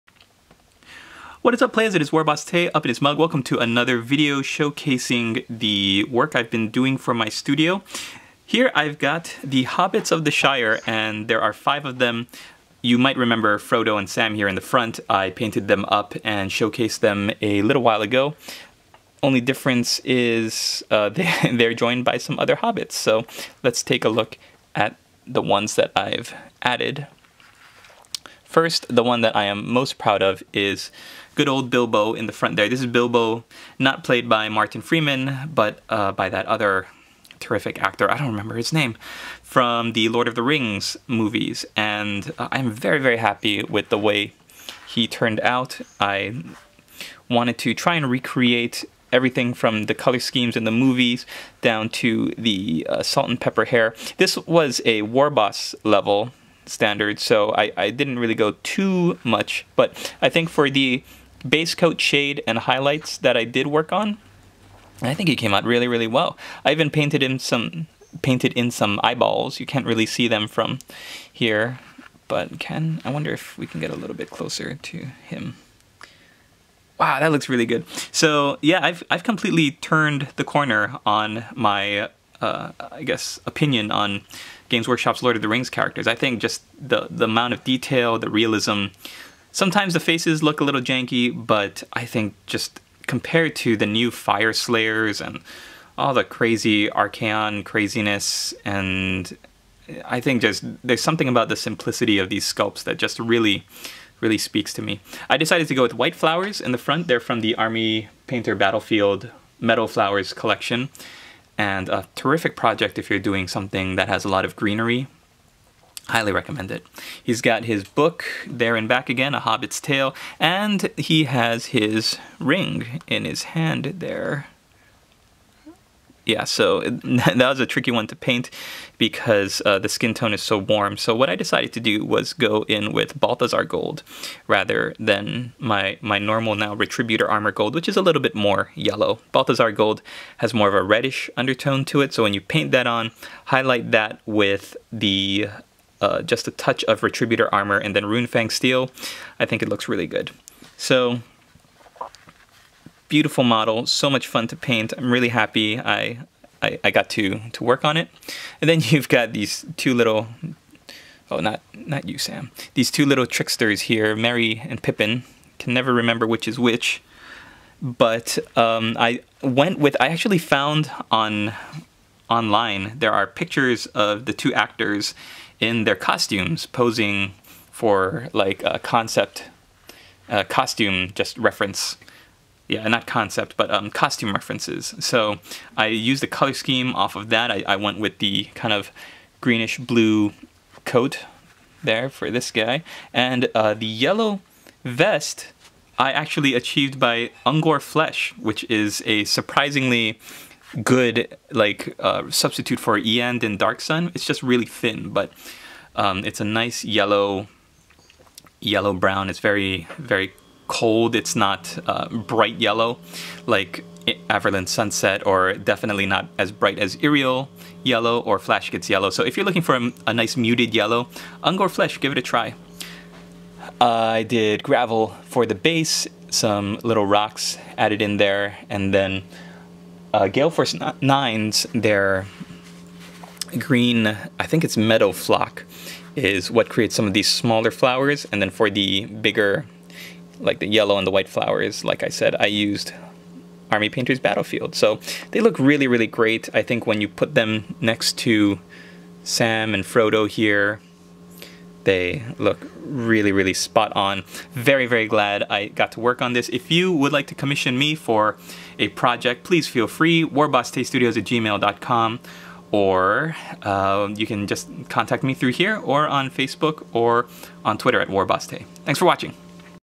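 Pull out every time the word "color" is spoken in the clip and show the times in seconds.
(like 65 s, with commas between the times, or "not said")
49 s, 186 s.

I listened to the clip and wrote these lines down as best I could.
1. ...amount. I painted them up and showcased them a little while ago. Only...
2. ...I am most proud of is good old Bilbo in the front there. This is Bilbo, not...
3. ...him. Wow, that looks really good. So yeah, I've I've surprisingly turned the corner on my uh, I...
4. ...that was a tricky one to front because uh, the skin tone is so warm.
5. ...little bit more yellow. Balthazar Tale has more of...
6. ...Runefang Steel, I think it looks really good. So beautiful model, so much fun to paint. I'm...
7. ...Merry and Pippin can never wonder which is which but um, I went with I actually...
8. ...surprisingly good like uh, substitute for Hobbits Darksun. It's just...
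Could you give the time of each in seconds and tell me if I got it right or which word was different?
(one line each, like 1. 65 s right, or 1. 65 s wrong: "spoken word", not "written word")
1. 14 s wrong: "front", not "amount"
2. 29 s right
3. 75 s wrong: "completely", not "surprisingly"
4. 126 s wrong: "paint", not "front"
5. 138 s wrong: "Gold", not "Tale"
6. 148 s right
7. 164 s wrong: "remember", not "wonder"
8. 199 s wrong: "Iyanden", not "Hobbits".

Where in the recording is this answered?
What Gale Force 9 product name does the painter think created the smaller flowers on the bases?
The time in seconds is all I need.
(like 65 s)
234 s.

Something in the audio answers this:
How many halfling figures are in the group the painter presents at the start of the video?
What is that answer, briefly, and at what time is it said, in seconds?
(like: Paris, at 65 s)
5, at 11 s.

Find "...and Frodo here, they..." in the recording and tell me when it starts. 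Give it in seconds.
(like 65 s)
249 s.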